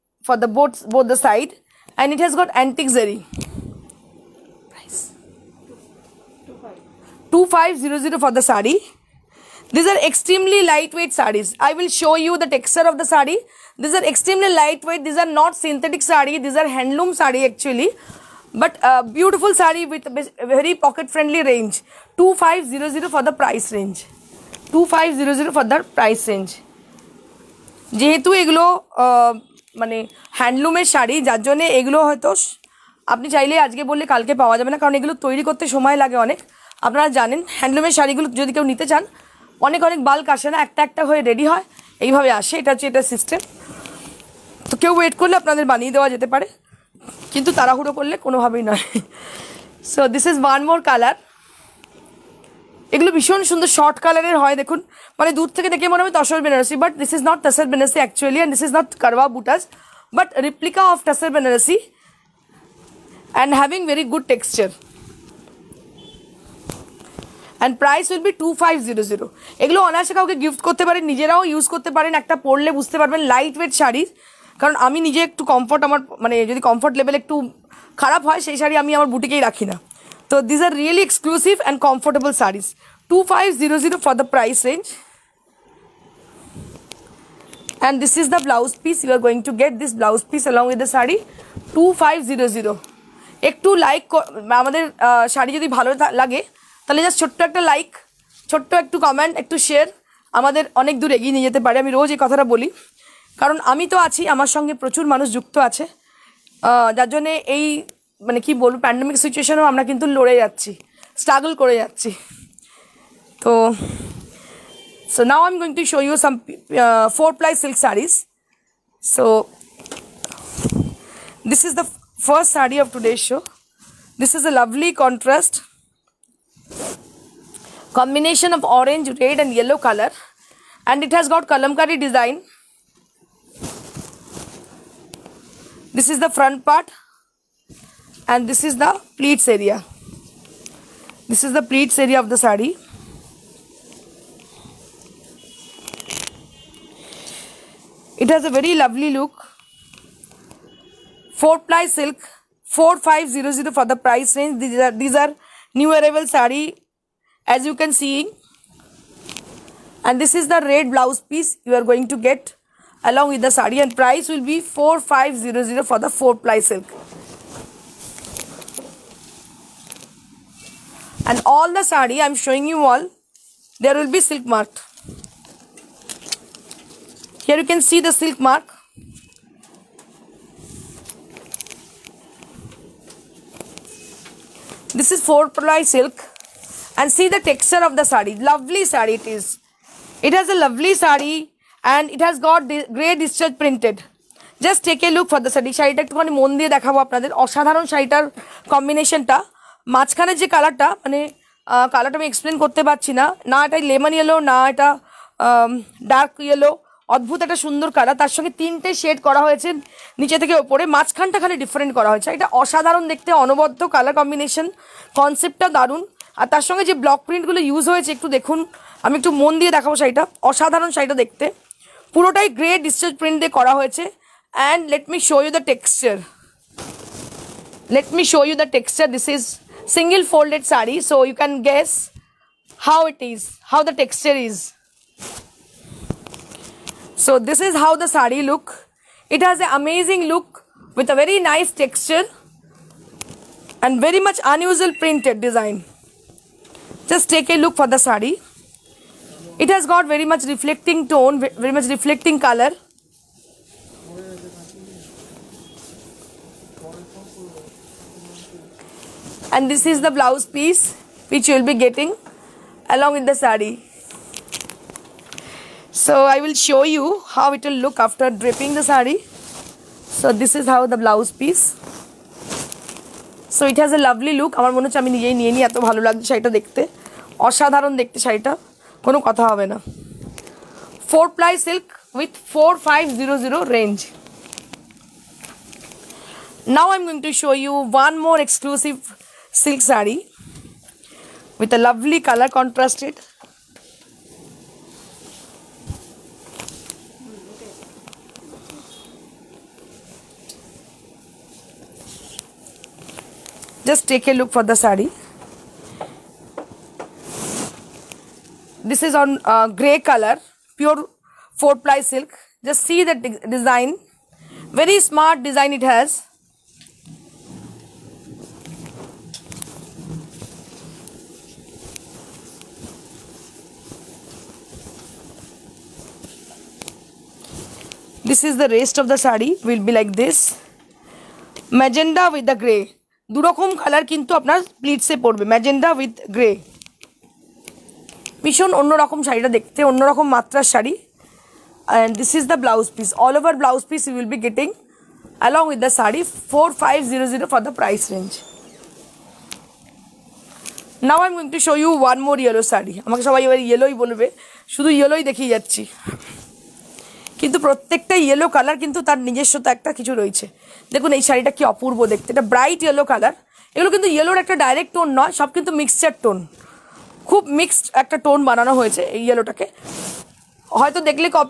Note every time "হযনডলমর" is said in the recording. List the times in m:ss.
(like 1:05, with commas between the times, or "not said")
0:30, 0:37.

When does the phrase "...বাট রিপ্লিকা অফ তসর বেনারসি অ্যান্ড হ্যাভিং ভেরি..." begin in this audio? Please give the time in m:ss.
1:00.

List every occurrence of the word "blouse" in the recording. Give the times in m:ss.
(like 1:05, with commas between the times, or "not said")
2:40, 4:20, 4:30.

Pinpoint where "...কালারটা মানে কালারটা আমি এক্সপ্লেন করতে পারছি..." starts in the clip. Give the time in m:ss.
3:20.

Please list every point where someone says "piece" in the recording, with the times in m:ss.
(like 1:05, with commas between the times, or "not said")
2:41, 4:20, 4:31.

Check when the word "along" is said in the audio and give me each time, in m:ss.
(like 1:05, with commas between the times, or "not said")
2:43, 4:22, 5:45.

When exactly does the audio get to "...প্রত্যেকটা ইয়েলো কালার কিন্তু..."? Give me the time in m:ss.
5:57.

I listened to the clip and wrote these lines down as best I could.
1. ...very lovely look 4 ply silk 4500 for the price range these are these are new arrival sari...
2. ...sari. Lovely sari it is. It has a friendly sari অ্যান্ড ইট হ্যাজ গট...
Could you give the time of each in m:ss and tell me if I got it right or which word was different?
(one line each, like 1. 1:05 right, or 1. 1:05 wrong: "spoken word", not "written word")
1. 2:28 right
2. 3:08 wrong: "lovely", not "friendly".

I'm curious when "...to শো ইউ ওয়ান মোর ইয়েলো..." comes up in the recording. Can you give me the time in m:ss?
5:51.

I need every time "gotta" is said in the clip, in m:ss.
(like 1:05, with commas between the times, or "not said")
not said.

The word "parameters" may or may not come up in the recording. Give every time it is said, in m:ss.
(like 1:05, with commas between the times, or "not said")
not said.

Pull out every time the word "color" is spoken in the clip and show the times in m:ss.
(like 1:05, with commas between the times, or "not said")
4:12, 4:52, 5:09, 5:33.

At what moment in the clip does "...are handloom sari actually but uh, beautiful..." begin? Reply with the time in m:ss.
0:16.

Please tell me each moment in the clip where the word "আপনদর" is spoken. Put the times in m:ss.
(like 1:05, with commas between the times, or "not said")
0:45, 3:17.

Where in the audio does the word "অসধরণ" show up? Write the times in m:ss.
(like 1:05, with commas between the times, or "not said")
3:17, 3:32, 3:40, 4:37.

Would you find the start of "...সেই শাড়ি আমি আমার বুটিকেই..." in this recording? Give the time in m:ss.
1:18.